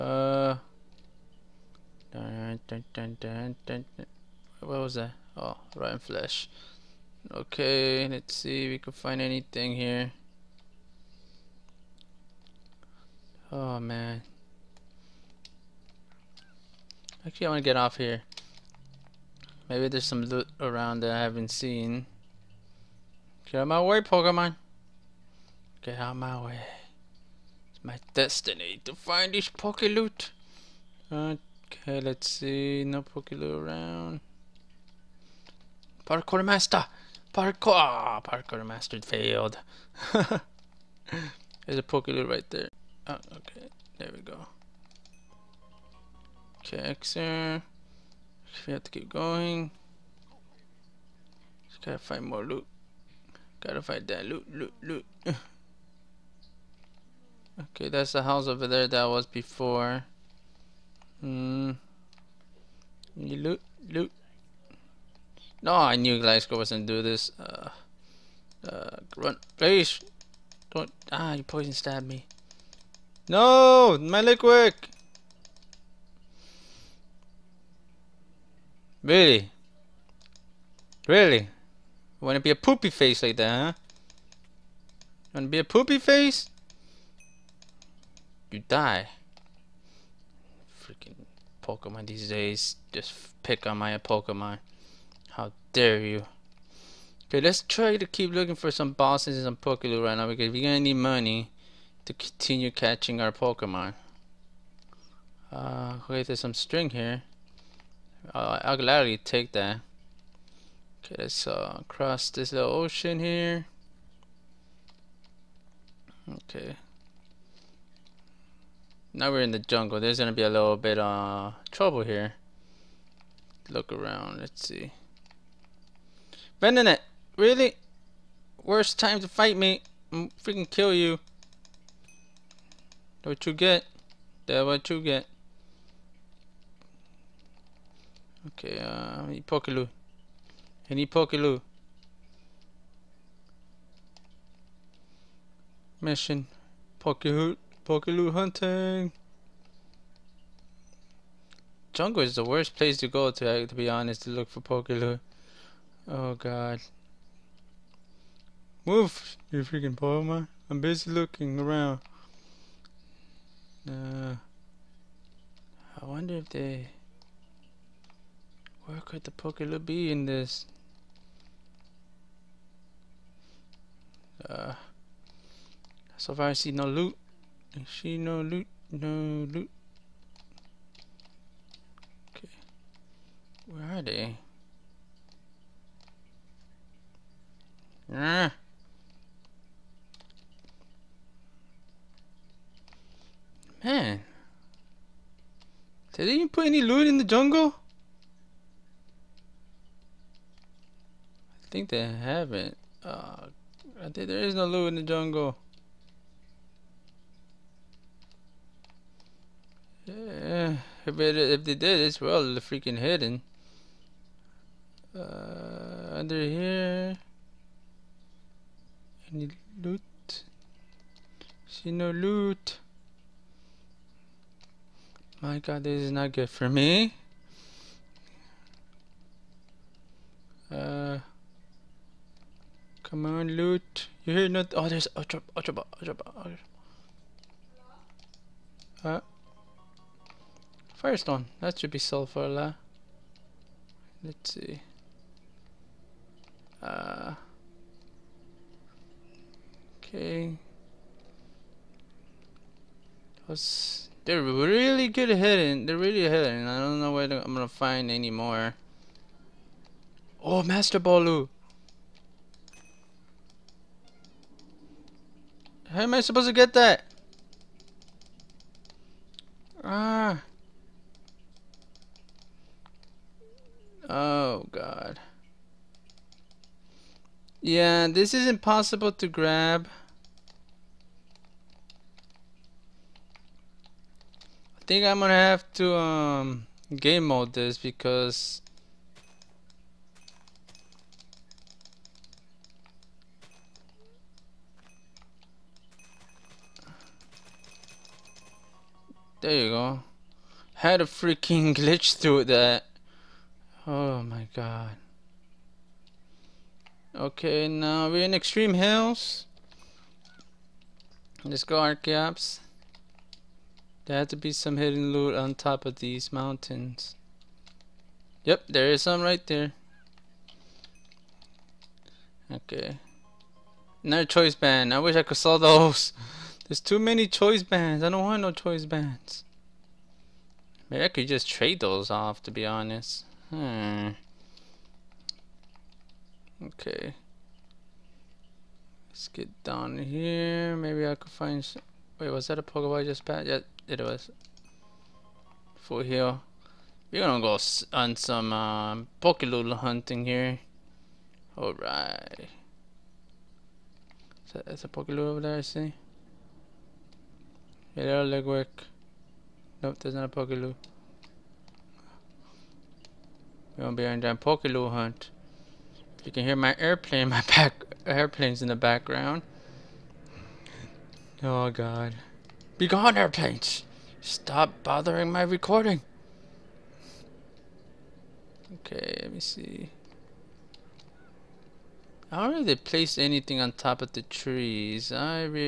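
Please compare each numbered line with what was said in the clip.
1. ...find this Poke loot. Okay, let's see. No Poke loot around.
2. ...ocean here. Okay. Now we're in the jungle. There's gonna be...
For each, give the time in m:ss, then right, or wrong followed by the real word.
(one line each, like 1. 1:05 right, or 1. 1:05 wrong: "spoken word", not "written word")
1. 0:28 right
2. 1:52 right.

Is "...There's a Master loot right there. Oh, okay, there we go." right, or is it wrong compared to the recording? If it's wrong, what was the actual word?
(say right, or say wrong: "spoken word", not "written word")
wrong: "Poke", not "Master".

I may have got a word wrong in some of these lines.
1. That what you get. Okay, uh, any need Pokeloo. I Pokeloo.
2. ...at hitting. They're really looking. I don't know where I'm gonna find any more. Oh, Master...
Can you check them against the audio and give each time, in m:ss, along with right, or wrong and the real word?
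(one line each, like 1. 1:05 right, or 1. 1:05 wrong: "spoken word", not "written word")
1. 2:14 right
2. 4:15 wrong: "hitting", not "looking".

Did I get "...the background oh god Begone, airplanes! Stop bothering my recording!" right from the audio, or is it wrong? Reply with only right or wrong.
right.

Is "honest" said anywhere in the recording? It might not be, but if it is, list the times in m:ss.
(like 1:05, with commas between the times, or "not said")
2:33, 5:32.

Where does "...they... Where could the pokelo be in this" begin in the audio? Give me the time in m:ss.
2:46.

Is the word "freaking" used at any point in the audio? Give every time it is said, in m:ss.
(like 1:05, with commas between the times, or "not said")
1:30, 2:10, 2:39, 3:32, 5:01.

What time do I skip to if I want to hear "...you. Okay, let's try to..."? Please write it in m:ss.
1:35.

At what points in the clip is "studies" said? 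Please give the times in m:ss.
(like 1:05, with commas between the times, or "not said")
not said.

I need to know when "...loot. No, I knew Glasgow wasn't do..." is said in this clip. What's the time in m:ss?
1:03.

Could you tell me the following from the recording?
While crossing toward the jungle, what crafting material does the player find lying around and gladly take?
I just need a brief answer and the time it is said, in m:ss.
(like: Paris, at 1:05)
String, at 1:46.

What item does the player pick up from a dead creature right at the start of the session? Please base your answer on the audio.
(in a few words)
Rotten flesh.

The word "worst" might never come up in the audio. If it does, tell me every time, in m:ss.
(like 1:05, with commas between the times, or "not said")
2:08, 2:32.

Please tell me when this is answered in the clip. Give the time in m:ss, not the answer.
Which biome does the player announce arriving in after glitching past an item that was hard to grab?
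5:08.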